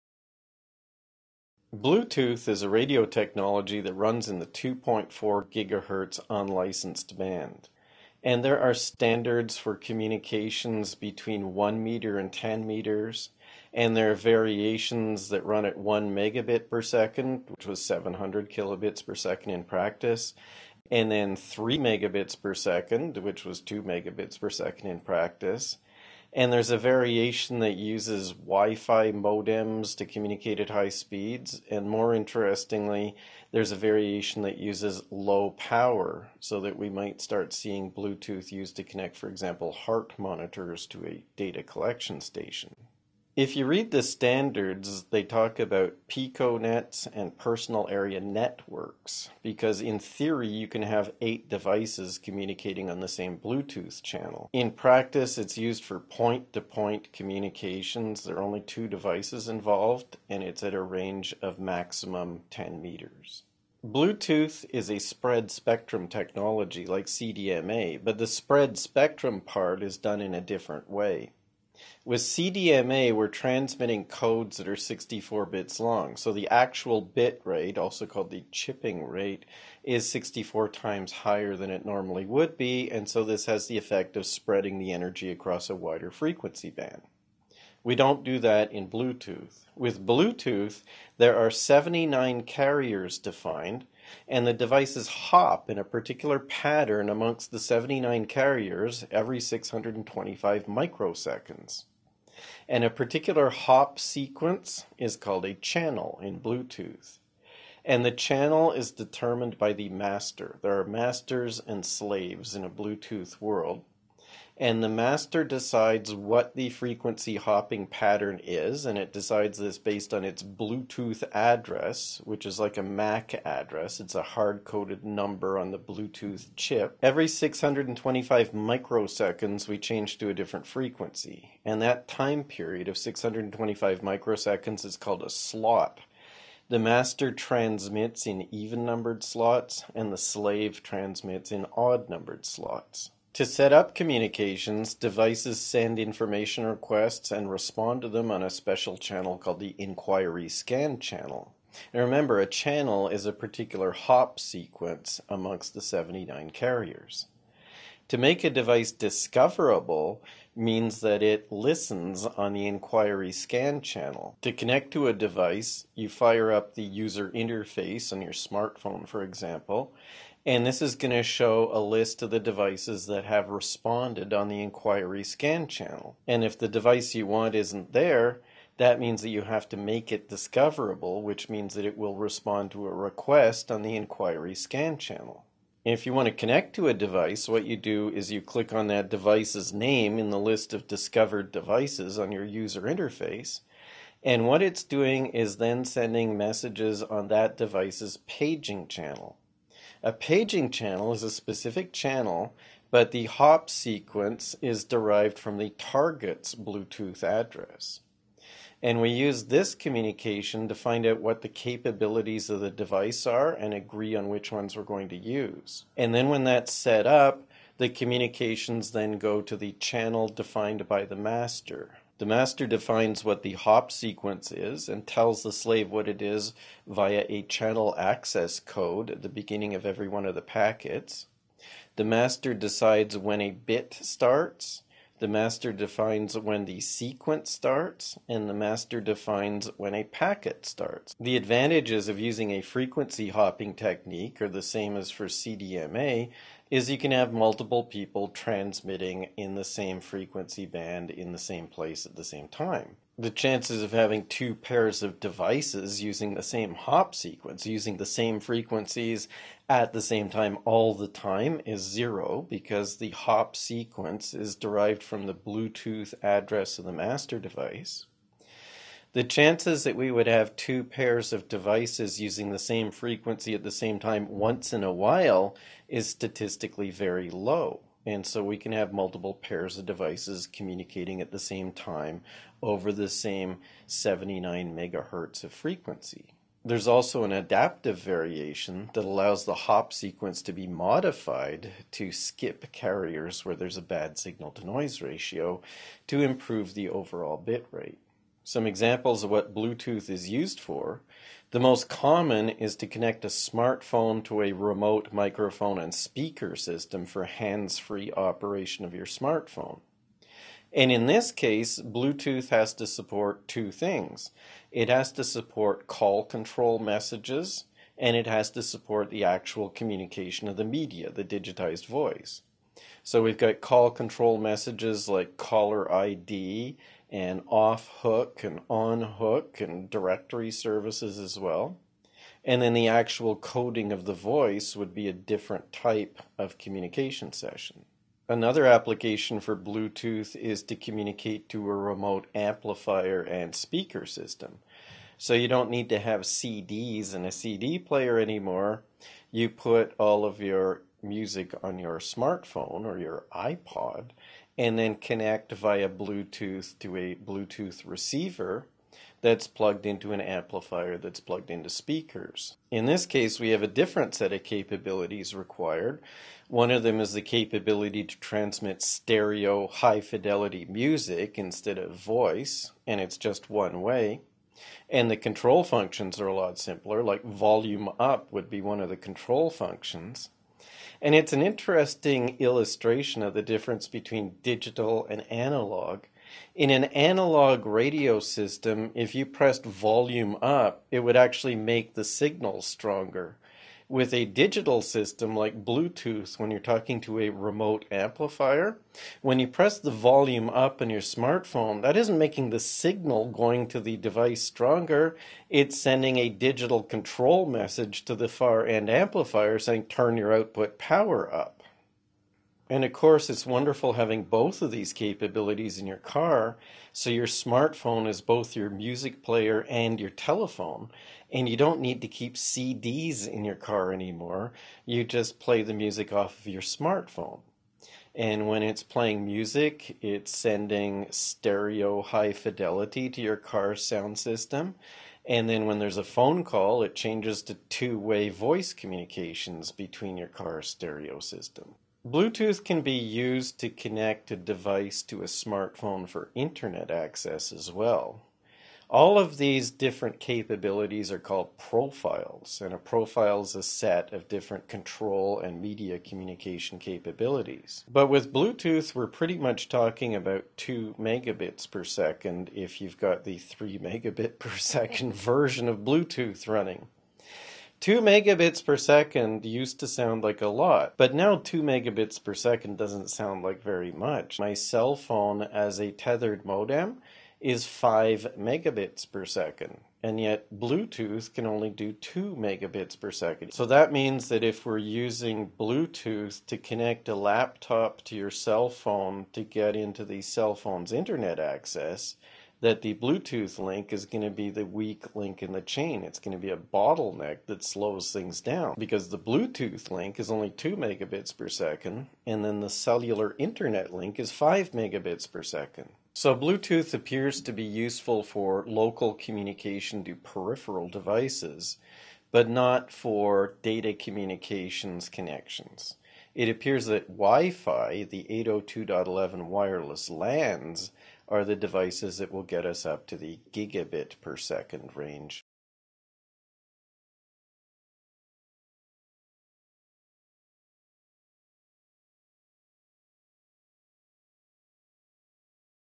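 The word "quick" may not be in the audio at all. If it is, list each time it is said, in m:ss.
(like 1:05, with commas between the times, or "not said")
not said.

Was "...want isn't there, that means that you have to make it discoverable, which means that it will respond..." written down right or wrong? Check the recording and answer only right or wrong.
right.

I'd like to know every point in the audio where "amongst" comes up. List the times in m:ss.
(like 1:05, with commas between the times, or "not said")
1:37, 2:35.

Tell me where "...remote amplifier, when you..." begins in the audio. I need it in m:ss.
6:37.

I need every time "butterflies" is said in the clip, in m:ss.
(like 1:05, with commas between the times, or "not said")
not said.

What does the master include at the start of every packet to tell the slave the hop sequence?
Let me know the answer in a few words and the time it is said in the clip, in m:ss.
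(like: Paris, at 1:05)
channel access code, at 3:47.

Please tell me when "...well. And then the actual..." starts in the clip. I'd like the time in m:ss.
5:31.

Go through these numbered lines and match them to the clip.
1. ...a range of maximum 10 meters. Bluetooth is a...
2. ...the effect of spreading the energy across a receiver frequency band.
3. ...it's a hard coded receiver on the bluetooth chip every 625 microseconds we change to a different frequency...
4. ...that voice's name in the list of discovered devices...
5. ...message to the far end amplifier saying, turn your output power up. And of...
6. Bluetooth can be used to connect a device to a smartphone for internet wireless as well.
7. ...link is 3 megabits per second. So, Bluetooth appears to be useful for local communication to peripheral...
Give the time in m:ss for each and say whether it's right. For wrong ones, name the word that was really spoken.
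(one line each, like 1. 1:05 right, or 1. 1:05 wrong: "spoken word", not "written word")
1. 1:00 right
2. 1:23 wrong: "wider", not "receiver"
3. 2:03 wrong: "number", not "receiver"
4. 3:08 wrong: "device", not "voice"
5. 6:47 right
6. 7:22 wrong: "access", not "wireless"
7. 8:23 wrong: "5", not "3".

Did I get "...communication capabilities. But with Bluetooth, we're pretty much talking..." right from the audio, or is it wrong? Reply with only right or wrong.
right.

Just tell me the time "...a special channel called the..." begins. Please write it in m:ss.
2:28.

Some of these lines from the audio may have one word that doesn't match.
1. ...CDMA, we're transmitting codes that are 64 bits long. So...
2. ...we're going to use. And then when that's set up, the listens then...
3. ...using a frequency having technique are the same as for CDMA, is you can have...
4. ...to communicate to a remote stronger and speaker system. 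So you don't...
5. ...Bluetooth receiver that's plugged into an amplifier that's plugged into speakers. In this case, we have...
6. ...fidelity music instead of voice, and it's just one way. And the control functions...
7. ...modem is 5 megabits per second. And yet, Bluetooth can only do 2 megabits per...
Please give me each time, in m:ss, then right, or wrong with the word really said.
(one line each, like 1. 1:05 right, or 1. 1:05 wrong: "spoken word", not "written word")
1. 1:12 right
2. 3:34 wrong: "communications", not "listens"
3. 4:02 wrong: "hopping", not "having"
4. 5:40 wrong: "amplifier", not "stronger"
5. 5:57 right
6. 6:10 right
7. 7:56 right.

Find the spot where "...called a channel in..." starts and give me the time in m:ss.
1:45.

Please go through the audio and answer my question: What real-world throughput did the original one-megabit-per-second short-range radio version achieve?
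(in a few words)
700 kilobits per second.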